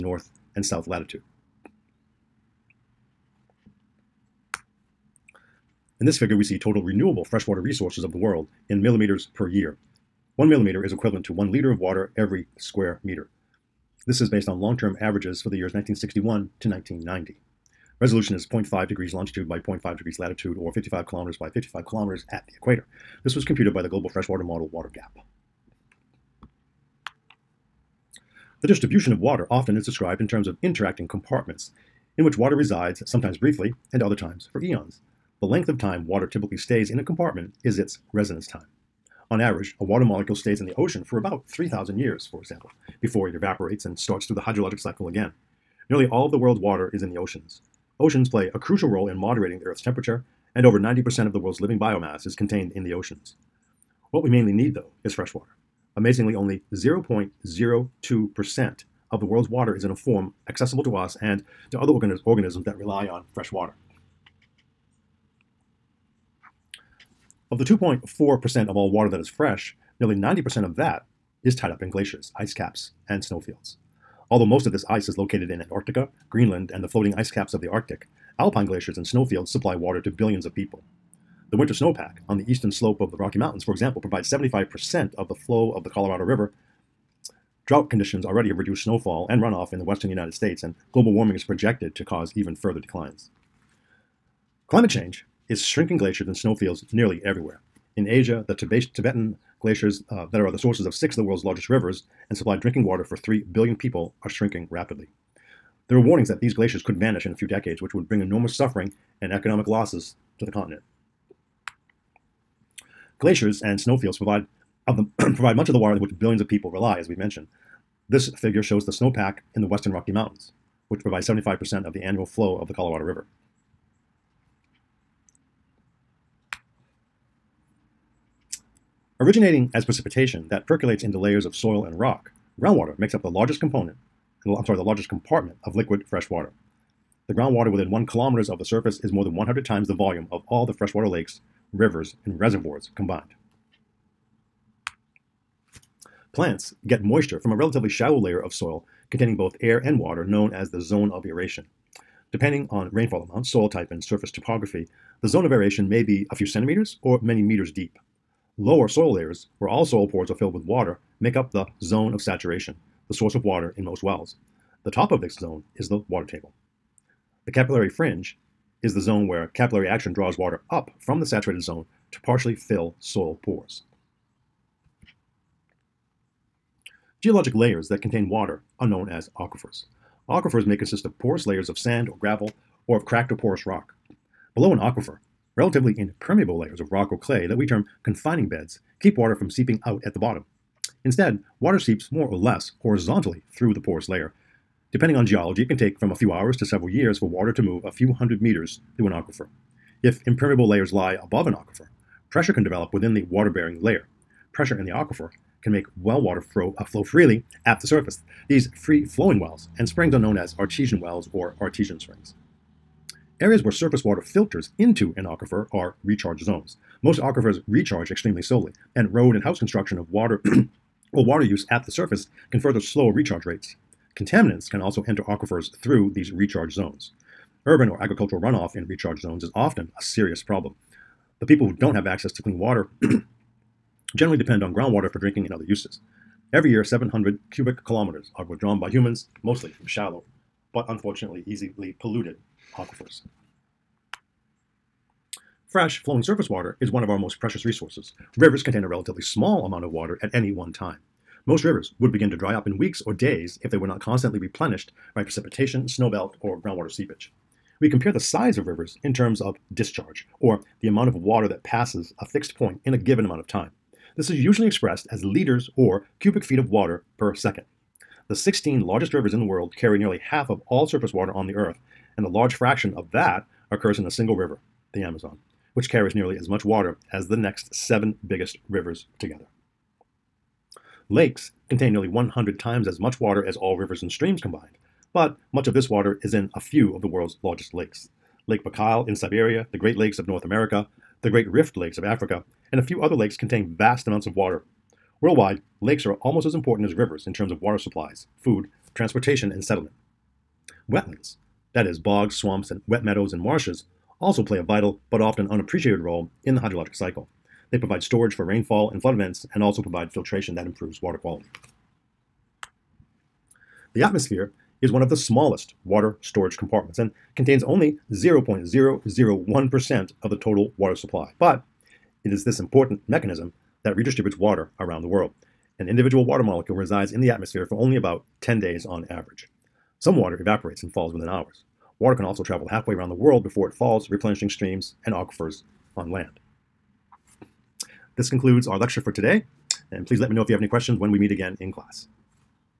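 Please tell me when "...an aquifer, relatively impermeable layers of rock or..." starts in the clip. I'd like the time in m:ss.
3:04.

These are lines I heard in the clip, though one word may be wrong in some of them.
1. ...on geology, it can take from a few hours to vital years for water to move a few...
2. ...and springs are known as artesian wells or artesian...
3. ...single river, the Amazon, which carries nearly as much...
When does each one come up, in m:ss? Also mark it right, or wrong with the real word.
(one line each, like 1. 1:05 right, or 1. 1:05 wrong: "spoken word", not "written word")
1. 3:15 wrong: "several", not "vital"
2. 3:29 right
3. 4:34 right.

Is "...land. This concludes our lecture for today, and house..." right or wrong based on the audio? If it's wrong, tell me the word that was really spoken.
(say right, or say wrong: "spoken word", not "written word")
wrong: "please", not "house".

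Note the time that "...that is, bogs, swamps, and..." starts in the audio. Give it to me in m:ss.
5:01.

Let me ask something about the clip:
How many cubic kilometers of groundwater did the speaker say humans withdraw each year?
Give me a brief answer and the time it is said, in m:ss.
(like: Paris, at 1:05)
700, at 3:56.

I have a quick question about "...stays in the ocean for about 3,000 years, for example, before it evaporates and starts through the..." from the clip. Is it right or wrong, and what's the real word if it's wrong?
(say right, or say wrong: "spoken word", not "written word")
right.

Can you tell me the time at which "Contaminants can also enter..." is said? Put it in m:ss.
3:44.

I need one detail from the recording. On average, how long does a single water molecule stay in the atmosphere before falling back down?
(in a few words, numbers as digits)
10 days.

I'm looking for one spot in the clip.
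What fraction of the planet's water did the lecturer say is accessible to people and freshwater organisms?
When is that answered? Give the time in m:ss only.
0:56.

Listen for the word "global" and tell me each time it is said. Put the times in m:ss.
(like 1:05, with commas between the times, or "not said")
0:23, 1:30.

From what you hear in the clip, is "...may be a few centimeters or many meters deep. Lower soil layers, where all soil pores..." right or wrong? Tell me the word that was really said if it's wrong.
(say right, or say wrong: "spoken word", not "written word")
right.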